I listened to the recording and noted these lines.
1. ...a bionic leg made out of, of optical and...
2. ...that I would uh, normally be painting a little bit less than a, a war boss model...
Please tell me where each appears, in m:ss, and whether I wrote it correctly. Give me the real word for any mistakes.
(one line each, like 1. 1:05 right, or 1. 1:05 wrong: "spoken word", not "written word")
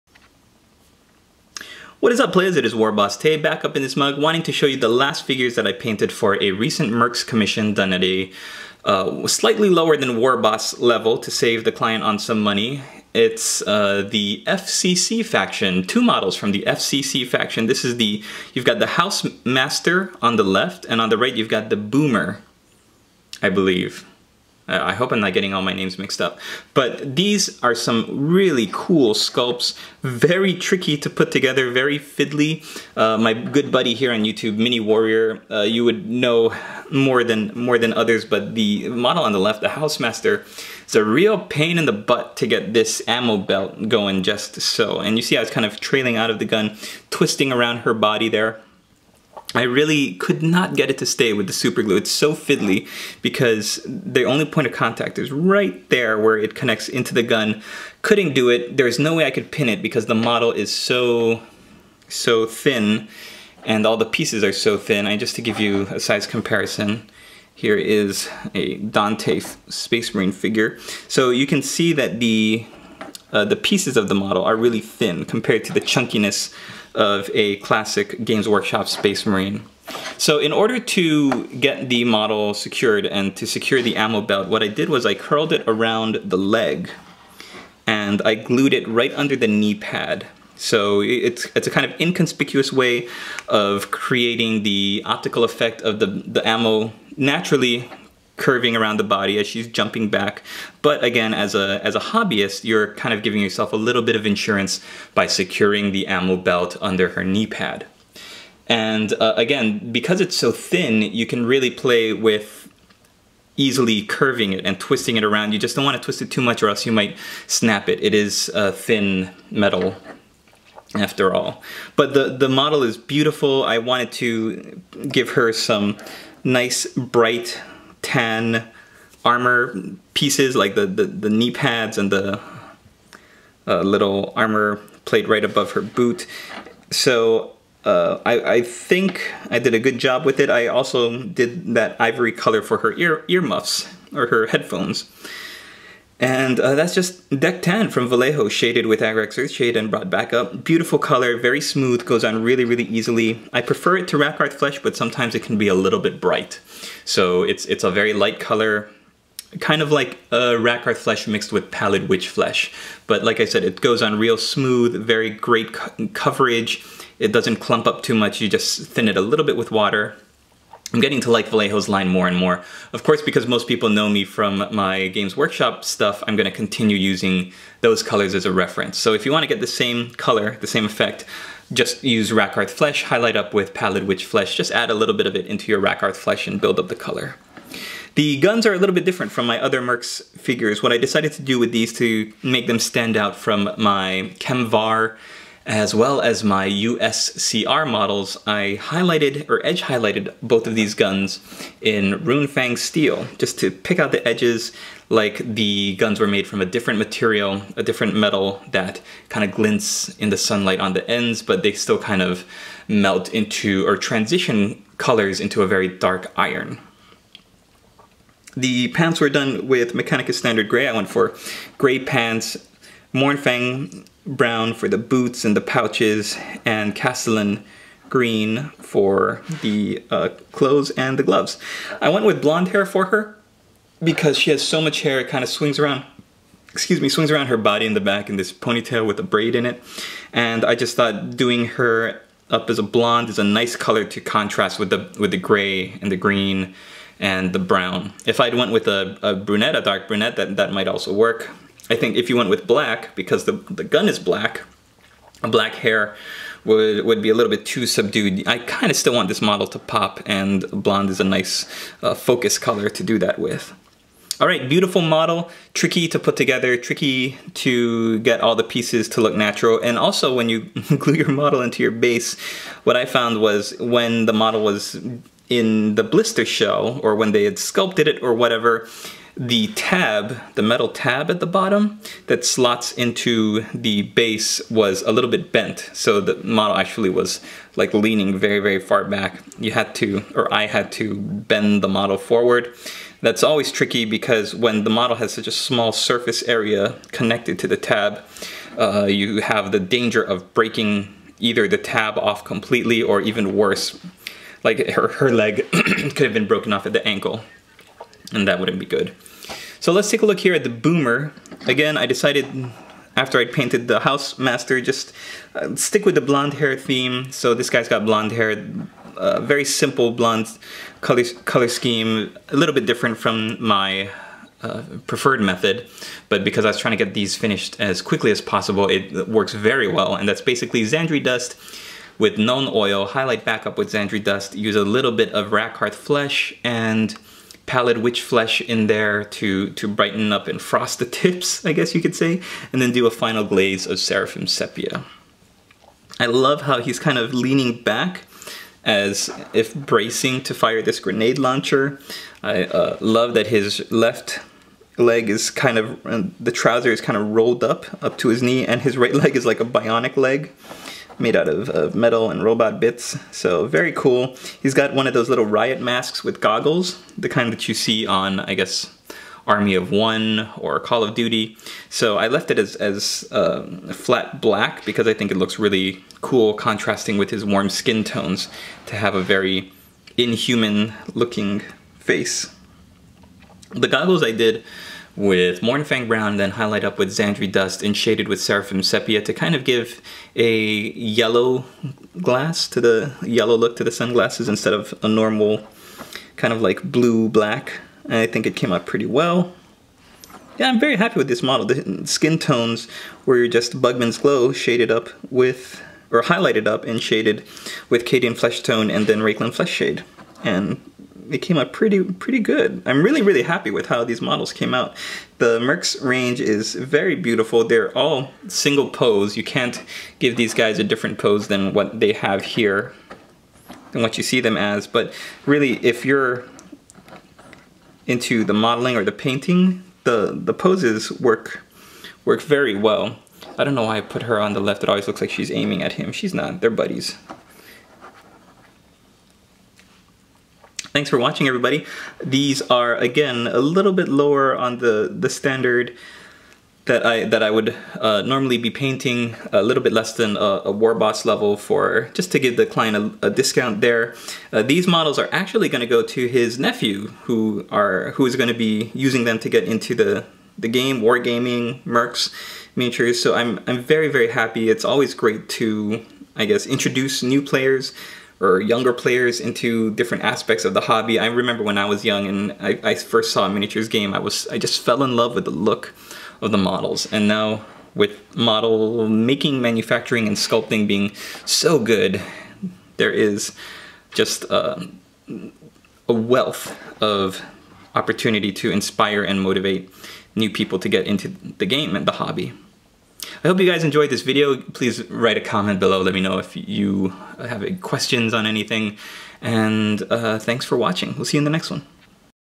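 1. 5:59 wrong: "metal", not "optical"
2. 7:27 wrong: "level", not "model".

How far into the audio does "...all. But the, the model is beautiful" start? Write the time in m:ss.
2:01.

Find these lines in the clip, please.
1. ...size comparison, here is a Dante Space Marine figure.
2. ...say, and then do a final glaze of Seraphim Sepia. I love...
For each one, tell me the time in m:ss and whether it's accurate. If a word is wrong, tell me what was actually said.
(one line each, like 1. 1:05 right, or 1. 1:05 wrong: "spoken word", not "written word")
1. 1:05 right
2. 5:42 right.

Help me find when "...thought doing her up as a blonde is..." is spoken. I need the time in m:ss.
4:00.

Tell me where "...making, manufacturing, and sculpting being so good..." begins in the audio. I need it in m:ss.
7:59.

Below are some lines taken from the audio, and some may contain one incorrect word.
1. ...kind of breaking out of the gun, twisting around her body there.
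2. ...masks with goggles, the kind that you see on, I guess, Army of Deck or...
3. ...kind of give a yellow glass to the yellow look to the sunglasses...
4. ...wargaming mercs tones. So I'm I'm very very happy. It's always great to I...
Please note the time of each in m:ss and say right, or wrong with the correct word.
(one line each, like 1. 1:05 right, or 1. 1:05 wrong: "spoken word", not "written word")
1. 0:45 wrong: "trailing", not "breaking"
2. 6:05 wrong: "One", not "Deck"
3. 6:29 right
4. 7:41 wrong: "miniatures", not "tones".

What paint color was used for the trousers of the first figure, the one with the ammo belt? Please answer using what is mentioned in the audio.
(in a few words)
Mechanicus Standard Gray.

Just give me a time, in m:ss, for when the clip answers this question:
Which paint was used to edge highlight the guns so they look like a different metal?
3:22.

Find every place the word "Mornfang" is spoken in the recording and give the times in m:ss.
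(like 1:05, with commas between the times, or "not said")
3:43, 6:25.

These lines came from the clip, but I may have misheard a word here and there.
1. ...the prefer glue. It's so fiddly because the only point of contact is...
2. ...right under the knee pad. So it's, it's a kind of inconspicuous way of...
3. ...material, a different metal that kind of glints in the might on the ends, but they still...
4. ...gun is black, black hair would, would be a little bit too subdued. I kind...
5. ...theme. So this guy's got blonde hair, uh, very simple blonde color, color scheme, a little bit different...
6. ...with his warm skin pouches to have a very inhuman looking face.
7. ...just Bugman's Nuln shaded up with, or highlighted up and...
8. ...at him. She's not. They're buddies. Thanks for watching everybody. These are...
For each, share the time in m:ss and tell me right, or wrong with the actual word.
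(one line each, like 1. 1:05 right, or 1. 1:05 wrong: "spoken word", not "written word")
1. 0:51 wrong: "super", not "prefer"
2. 1:28 right
3. 3:26 wrong: "sunlight", not "might"
4. 4:13 right
5. 5:16 right
6. 6:17 wrong: "tones", not "pouches"
7. 6:43 wrong: "Glow", not "Nuln"
8. 7:15 right.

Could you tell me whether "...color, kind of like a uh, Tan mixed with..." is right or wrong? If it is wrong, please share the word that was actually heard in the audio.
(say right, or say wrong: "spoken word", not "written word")
wrong: "Flesh", not "Tan".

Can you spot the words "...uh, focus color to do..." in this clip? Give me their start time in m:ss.
4:22.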